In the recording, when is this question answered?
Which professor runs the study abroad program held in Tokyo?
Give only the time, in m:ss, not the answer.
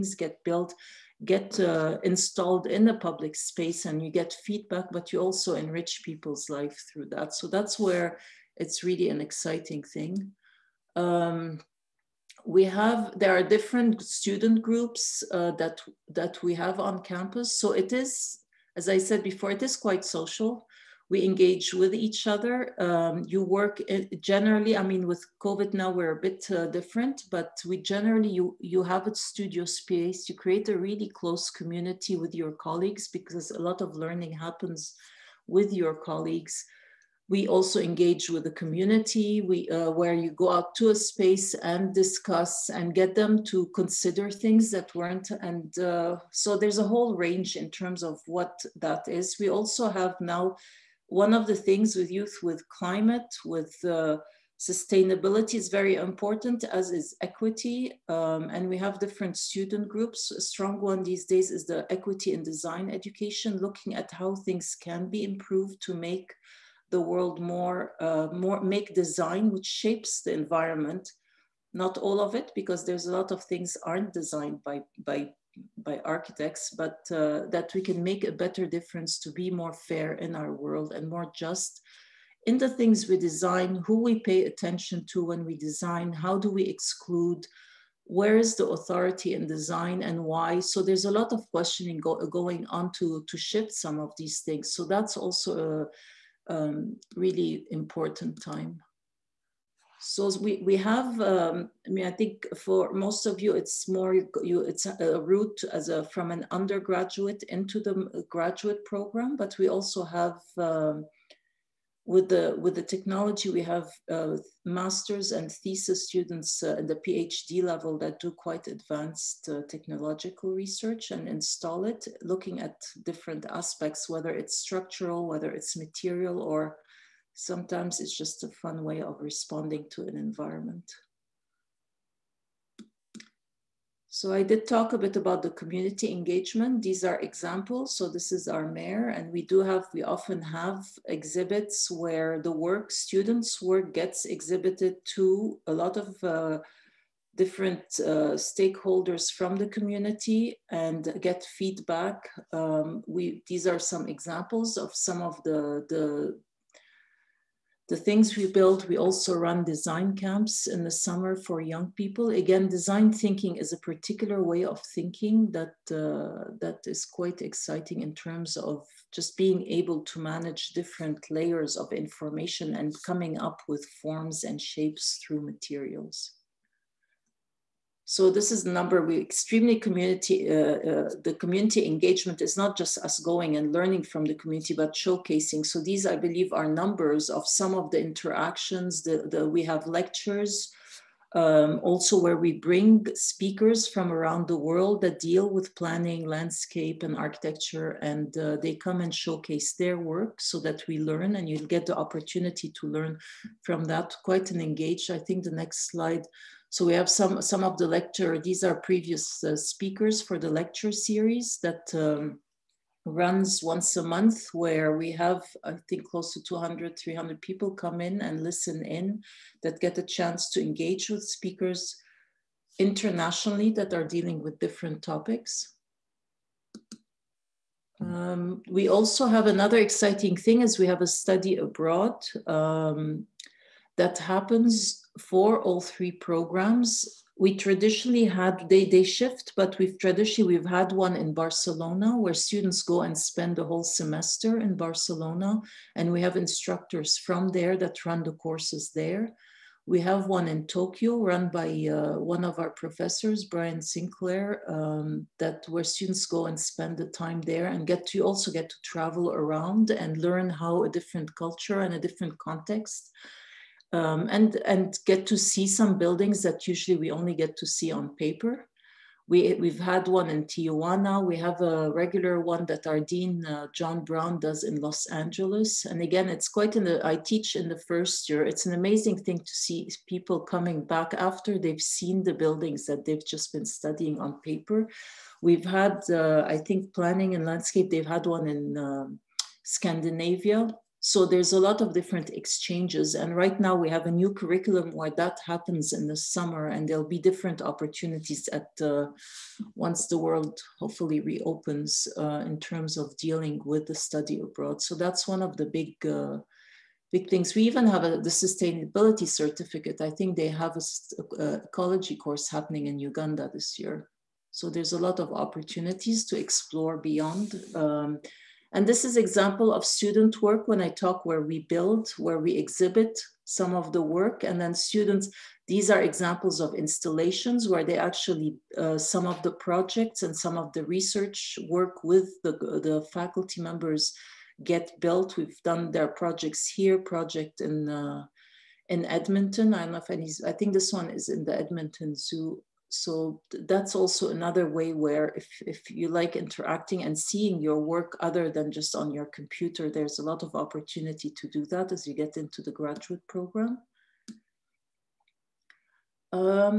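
4:13.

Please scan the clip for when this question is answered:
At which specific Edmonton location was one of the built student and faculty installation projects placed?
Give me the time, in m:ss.
5:41.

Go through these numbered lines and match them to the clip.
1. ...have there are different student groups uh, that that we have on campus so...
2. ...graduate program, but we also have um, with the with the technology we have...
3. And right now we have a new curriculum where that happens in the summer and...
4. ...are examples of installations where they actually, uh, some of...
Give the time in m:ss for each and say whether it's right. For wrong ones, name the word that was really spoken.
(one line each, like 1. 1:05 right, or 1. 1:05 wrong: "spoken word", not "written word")
1. 0:12 right
2. 1:48 right
3. 4:53 right
4. 5:25 right.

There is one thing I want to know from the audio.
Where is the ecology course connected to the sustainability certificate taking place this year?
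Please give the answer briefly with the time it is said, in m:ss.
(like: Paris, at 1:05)
Uganda, at 5:12.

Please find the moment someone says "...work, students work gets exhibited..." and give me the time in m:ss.
2:22.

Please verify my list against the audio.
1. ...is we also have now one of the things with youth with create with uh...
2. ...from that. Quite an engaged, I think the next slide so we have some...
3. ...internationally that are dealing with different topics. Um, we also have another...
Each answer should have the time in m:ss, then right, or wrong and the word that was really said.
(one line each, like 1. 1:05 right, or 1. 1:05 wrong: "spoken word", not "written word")
1. 0:49 wrong: "climate", not "create"
2. 3:23 right
3. 3:42 right.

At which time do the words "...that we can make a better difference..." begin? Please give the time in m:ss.
1:17.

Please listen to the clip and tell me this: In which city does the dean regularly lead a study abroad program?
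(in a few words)
Los Angeles.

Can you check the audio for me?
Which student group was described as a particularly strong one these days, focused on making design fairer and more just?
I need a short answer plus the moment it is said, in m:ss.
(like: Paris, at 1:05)
Equity in Design Education, at 1:01.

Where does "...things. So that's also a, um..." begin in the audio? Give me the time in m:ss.
1:34.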